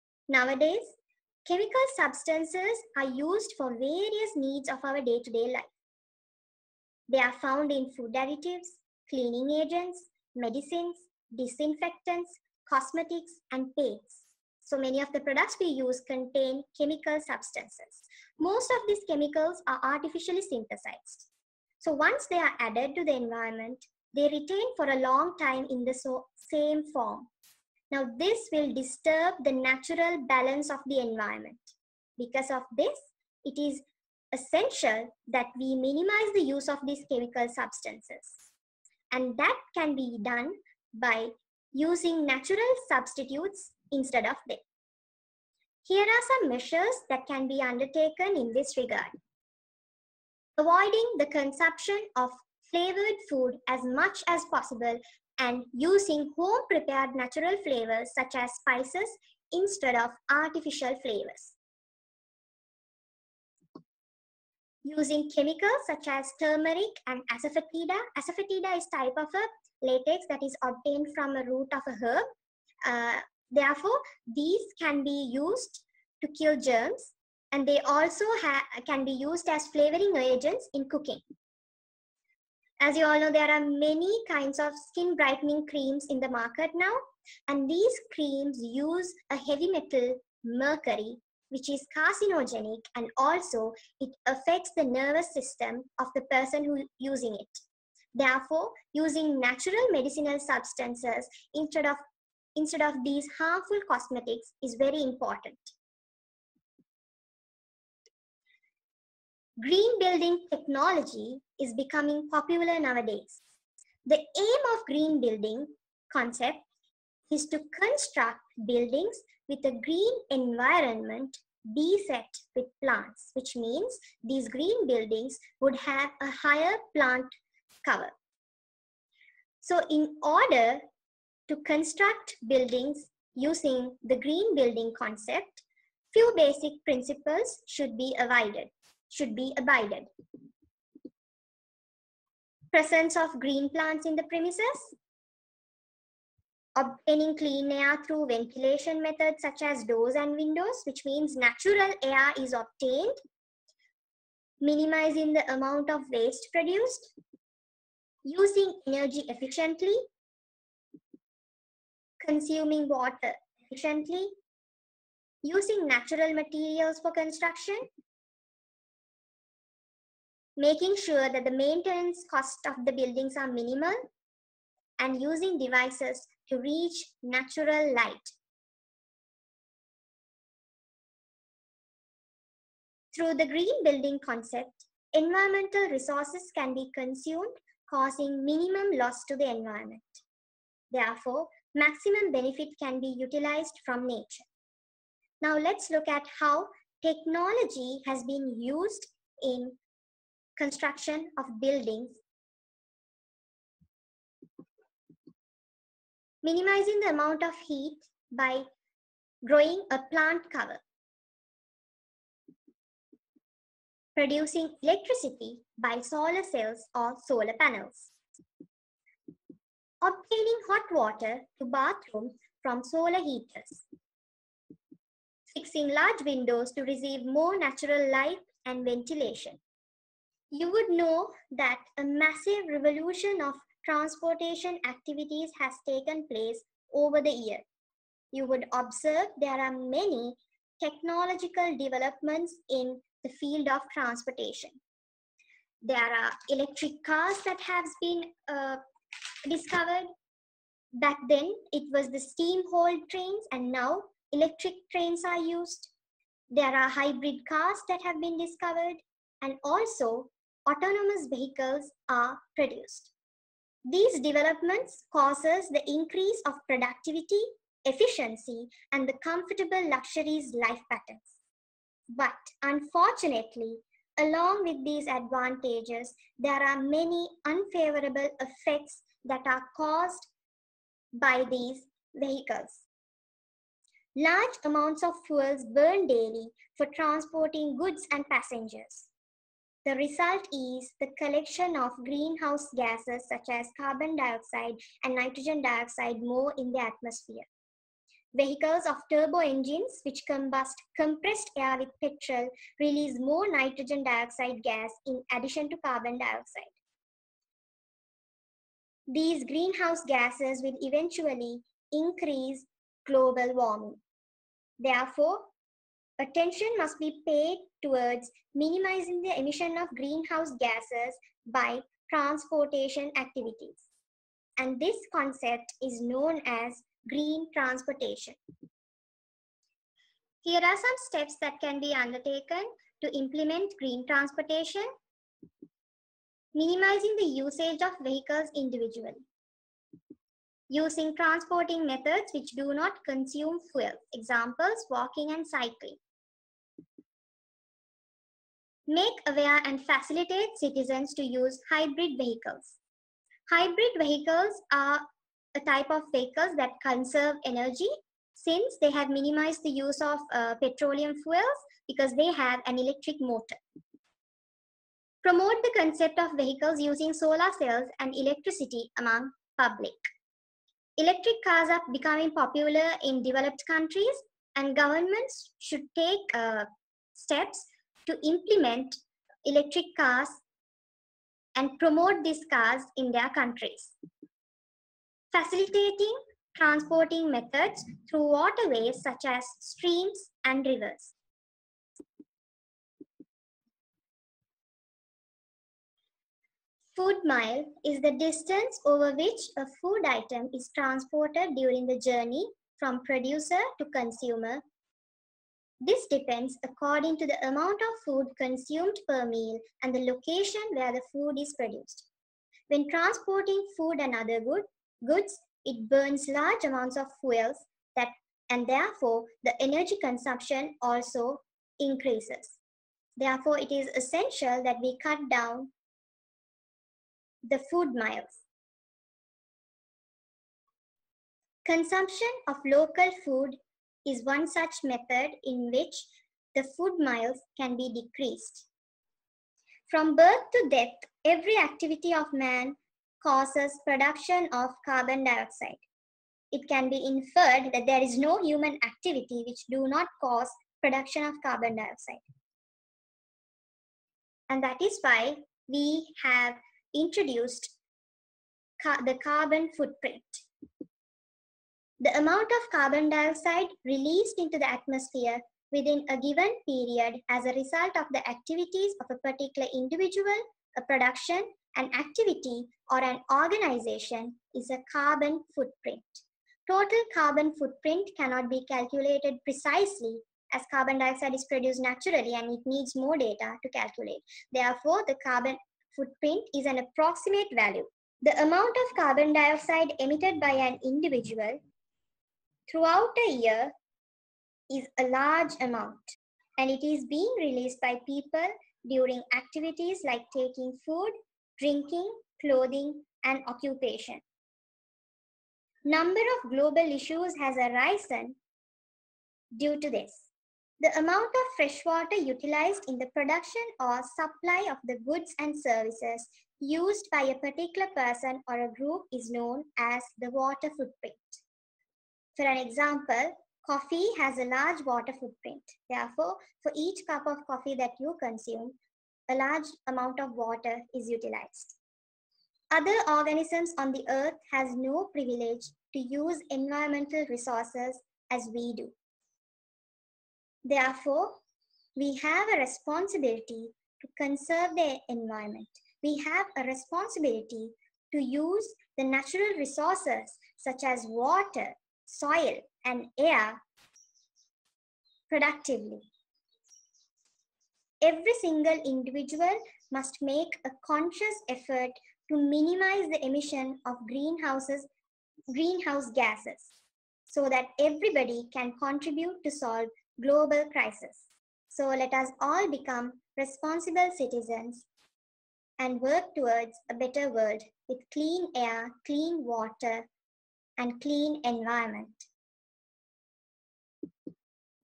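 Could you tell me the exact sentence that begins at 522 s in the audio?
For an example, coffee has a large water footprint.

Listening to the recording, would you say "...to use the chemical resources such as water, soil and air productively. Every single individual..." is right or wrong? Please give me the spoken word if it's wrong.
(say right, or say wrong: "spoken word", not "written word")
wrong: "natural", not "chemical".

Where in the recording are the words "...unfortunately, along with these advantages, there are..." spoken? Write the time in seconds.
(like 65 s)
272 s.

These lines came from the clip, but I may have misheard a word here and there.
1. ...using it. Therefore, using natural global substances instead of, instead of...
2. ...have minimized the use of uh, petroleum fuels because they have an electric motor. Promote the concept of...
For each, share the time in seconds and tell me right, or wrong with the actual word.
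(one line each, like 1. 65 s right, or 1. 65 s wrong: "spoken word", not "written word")
1. 96 s wrong: "medicinal", not "global"
2. 358 s right.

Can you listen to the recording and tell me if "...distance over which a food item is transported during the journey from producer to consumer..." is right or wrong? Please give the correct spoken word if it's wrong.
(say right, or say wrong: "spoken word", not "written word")
right.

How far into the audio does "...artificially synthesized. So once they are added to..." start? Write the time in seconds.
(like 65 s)
19 s.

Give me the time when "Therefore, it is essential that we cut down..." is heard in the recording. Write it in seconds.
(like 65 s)
423 s.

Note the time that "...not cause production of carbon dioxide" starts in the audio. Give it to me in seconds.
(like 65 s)
449 s.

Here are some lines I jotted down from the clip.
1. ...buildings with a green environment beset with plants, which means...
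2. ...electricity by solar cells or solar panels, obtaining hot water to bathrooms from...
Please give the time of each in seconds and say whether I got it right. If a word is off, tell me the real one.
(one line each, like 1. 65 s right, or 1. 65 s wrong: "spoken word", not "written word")
1. 118 s right
2. 214 s right.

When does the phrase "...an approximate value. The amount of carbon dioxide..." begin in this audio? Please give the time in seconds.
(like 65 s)
486 s.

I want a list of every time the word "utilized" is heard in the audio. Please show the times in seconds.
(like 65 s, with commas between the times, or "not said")
193 s, 512 s, 531 s.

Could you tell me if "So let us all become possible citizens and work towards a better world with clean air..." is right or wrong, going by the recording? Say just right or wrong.
wrong.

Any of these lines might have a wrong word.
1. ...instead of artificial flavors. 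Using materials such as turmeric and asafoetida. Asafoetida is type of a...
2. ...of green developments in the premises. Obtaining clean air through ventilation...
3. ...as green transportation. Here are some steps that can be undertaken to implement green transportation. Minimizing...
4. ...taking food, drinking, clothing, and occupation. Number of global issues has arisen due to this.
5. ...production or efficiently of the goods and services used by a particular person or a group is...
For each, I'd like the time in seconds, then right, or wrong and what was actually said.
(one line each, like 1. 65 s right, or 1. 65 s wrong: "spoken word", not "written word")
1. 59 s wrong: "chemicals", not "materials"
2. 143 s wrong: "plants", not "developments"
3. 326 s right
4. 500 s right
5. 513 s wrong: "supply", not "efficiently".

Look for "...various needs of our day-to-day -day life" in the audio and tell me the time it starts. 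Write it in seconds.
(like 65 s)
3 s.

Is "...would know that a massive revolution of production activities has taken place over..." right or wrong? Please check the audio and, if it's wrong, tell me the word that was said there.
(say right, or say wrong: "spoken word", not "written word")
wrong: "transportation", not "production".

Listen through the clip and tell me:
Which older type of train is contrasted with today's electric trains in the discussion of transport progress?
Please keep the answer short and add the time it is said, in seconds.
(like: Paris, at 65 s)
Steam hauled trains, at 252 s.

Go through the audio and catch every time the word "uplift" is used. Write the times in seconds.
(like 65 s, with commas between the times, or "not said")
not said.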